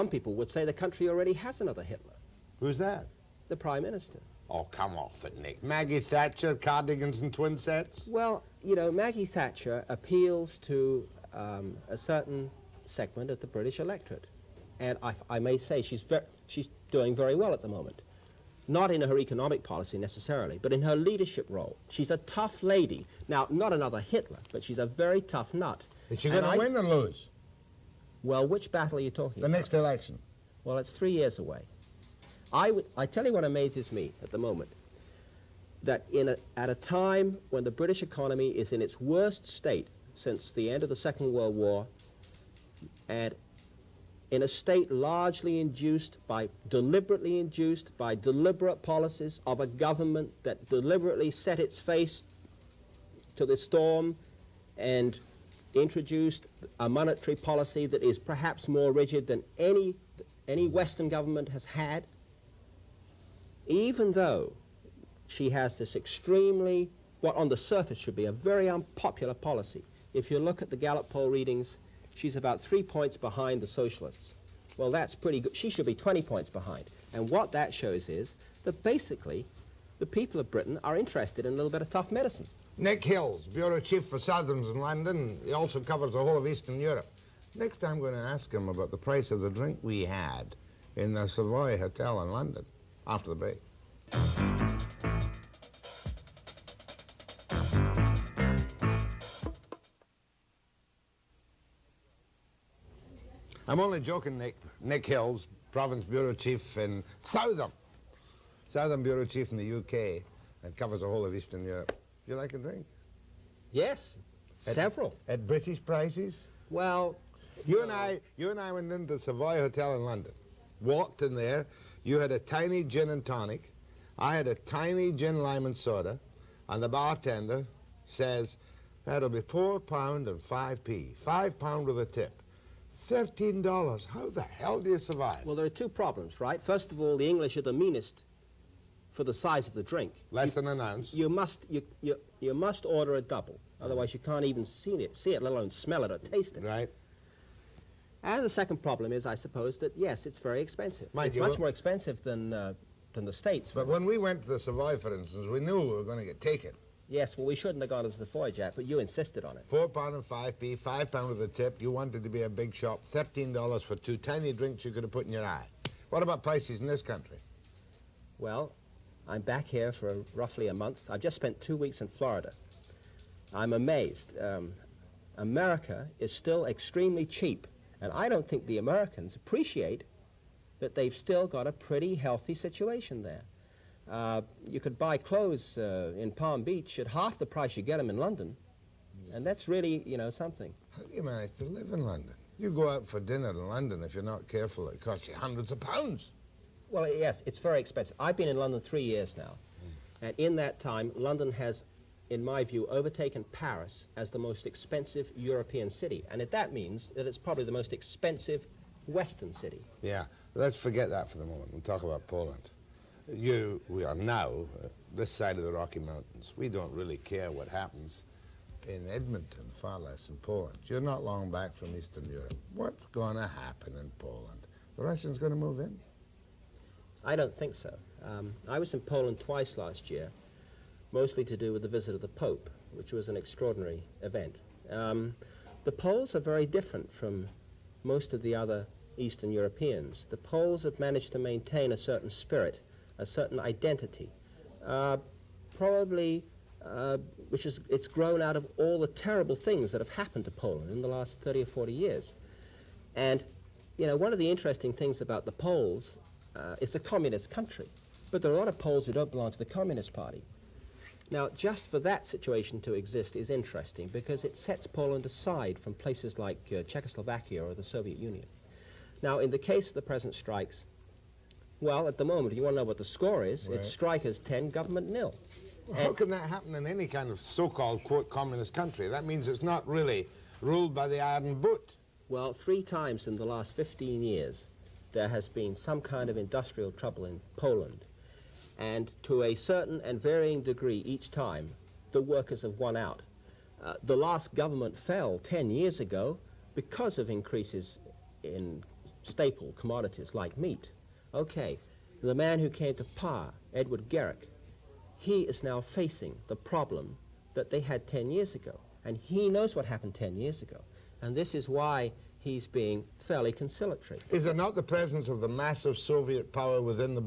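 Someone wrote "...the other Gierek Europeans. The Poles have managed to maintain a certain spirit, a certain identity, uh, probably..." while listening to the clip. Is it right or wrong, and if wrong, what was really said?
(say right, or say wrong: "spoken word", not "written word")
wrong: "Eastern", not "Gierek".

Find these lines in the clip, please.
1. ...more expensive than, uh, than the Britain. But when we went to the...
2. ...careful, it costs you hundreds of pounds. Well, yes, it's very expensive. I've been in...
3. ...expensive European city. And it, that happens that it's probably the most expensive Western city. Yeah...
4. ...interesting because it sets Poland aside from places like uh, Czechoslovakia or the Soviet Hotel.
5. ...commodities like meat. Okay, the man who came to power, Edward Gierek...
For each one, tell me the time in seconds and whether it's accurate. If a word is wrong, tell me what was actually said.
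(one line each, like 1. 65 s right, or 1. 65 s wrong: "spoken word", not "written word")
1. 151 s wrong: "States", not "Britain"
2. 194 s right
3. 204 s wrong: "means", not "happens"
4. 263 s wrong: "Union", not "Hotel"
5. 299 s right.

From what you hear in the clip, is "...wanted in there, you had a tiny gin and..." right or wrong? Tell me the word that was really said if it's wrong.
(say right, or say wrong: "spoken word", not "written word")
wrong: "walked", not "wanted".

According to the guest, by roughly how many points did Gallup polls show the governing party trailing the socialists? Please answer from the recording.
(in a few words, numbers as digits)
3.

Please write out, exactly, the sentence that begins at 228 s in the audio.
Um, I was in Poland twice last year, mostly to do with the visit of the Pope, which was an extraordinary event.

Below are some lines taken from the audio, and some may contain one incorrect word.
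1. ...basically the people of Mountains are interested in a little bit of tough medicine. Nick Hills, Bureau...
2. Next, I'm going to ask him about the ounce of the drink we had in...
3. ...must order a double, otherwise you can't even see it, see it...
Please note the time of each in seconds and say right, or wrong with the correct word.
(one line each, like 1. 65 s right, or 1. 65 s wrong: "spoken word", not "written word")
1. 78 s wrong: "Britain", not "Mountains"
2. 87 s wrong: "price", not "ounce"
3. 142 s right.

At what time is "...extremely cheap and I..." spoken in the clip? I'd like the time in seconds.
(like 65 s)
176 s.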